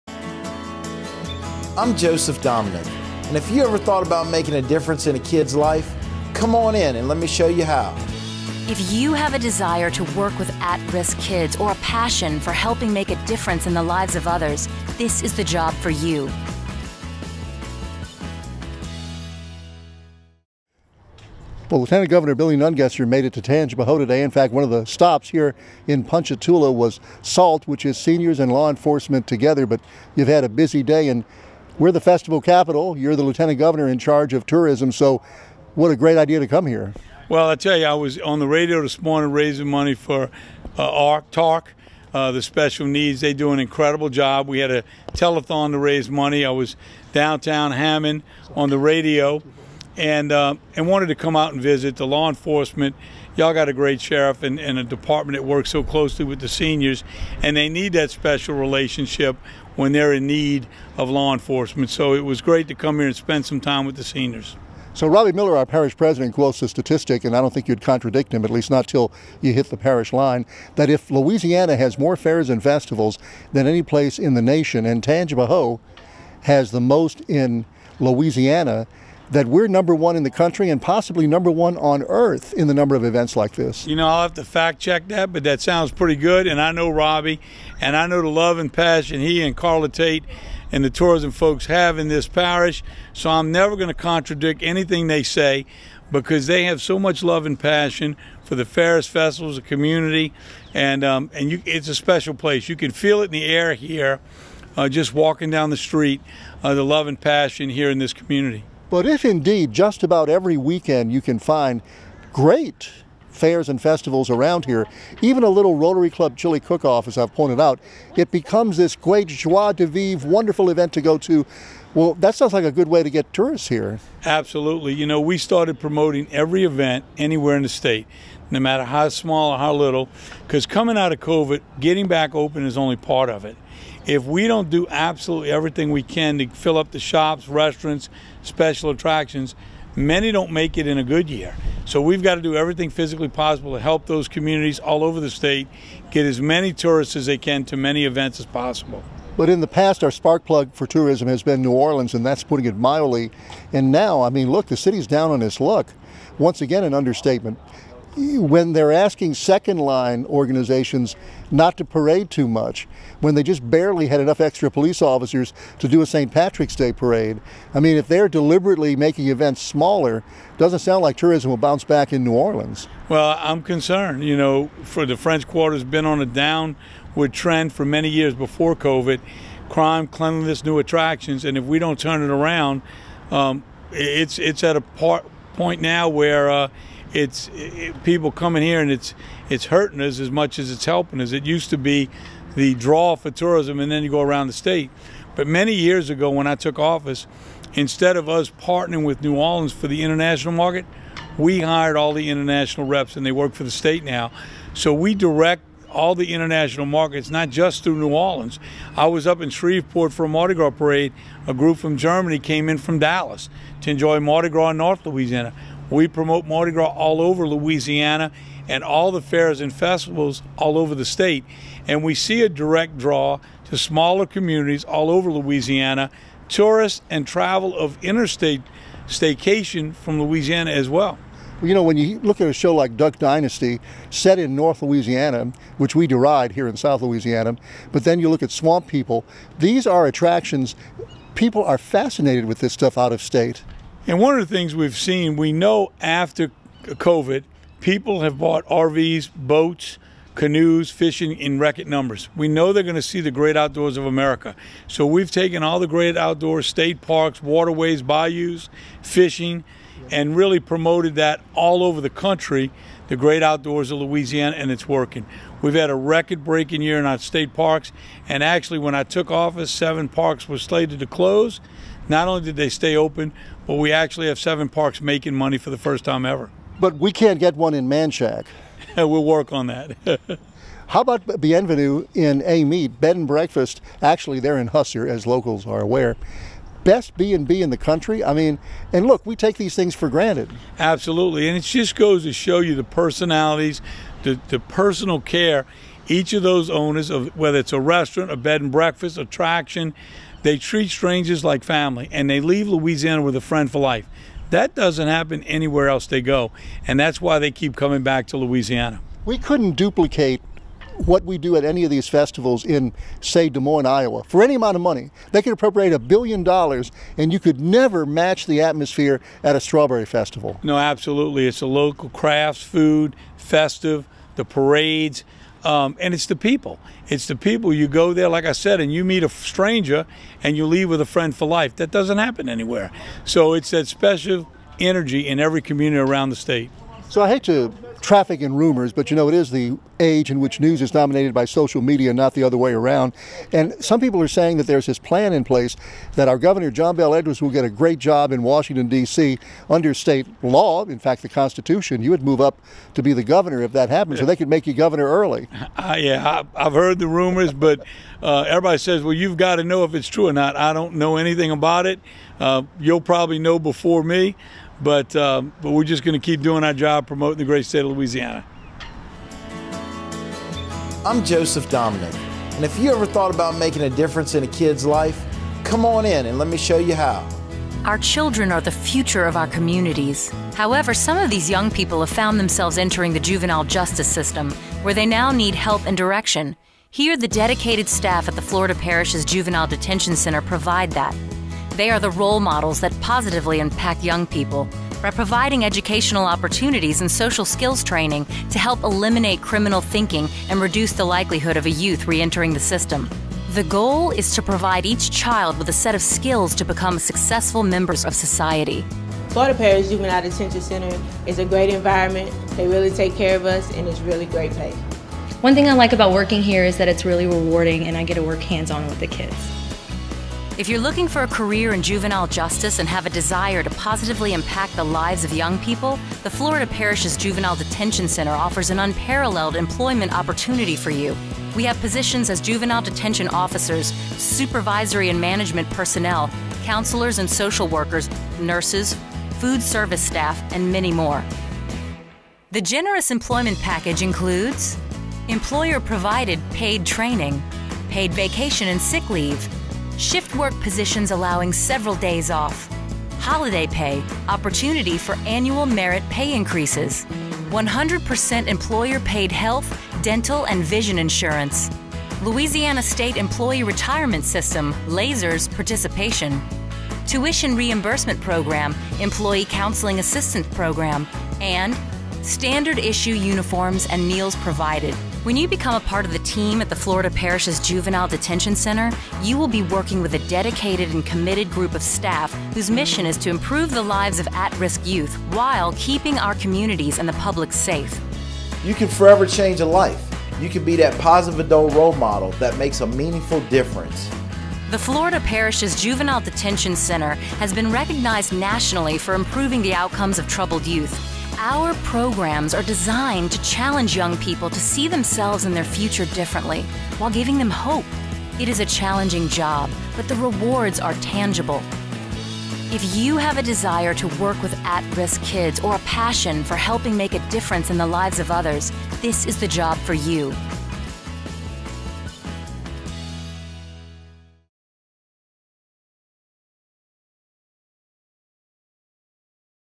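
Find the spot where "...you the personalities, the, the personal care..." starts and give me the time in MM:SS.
04:52.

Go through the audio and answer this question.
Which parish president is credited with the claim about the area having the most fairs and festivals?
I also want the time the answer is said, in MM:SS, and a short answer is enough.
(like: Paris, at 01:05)
Robbie Miller, at 01:05.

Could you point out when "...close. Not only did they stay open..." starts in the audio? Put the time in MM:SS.
04:31.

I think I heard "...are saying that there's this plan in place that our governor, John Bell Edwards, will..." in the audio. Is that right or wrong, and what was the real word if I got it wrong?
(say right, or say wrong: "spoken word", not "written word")
right.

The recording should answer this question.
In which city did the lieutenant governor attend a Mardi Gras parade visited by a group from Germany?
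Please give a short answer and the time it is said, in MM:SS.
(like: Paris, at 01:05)
Shreveport, at 03:29.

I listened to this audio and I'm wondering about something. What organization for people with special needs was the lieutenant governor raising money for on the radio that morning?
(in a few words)
ARC Talk.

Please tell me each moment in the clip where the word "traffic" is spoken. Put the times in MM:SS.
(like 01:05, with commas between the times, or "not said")
05:37.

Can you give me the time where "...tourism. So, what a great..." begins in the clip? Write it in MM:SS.
00:34.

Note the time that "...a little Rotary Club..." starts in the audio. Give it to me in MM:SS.
01:55.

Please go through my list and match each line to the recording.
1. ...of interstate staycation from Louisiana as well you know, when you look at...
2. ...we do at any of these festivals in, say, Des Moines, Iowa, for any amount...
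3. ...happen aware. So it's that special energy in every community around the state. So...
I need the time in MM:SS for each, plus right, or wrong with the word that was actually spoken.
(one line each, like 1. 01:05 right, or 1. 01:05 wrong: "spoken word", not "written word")
1. 03:47 right
2. 05:11 right
3. 05:32 wrong: "anywhere", not "aware".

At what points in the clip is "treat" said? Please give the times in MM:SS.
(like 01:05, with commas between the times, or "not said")
05:00.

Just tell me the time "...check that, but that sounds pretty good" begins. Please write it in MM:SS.
01:24.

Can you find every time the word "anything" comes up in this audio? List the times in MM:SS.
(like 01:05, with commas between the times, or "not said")
01:34, 06:01.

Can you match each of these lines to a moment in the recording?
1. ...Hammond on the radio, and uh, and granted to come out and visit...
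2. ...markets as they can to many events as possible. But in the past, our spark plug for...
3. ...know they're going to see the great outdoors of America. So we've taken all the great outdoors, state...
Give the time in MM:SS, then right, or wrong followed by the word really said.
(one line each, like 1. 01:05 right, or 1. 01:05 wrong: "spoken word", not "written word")
1. 00:47 wrong: "wanted", not "granted"
2. 02:26 wrong: "tourists", not "markets"
3. 04:12 right.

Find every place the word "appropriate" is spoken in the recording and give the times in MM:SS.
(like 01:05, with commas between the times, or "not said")
05:15.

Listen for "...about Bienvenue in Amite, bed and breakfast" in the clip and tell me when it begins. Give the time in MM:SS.
04:41.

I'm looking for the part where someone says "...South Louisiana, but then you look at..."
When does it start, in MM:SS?
03:56.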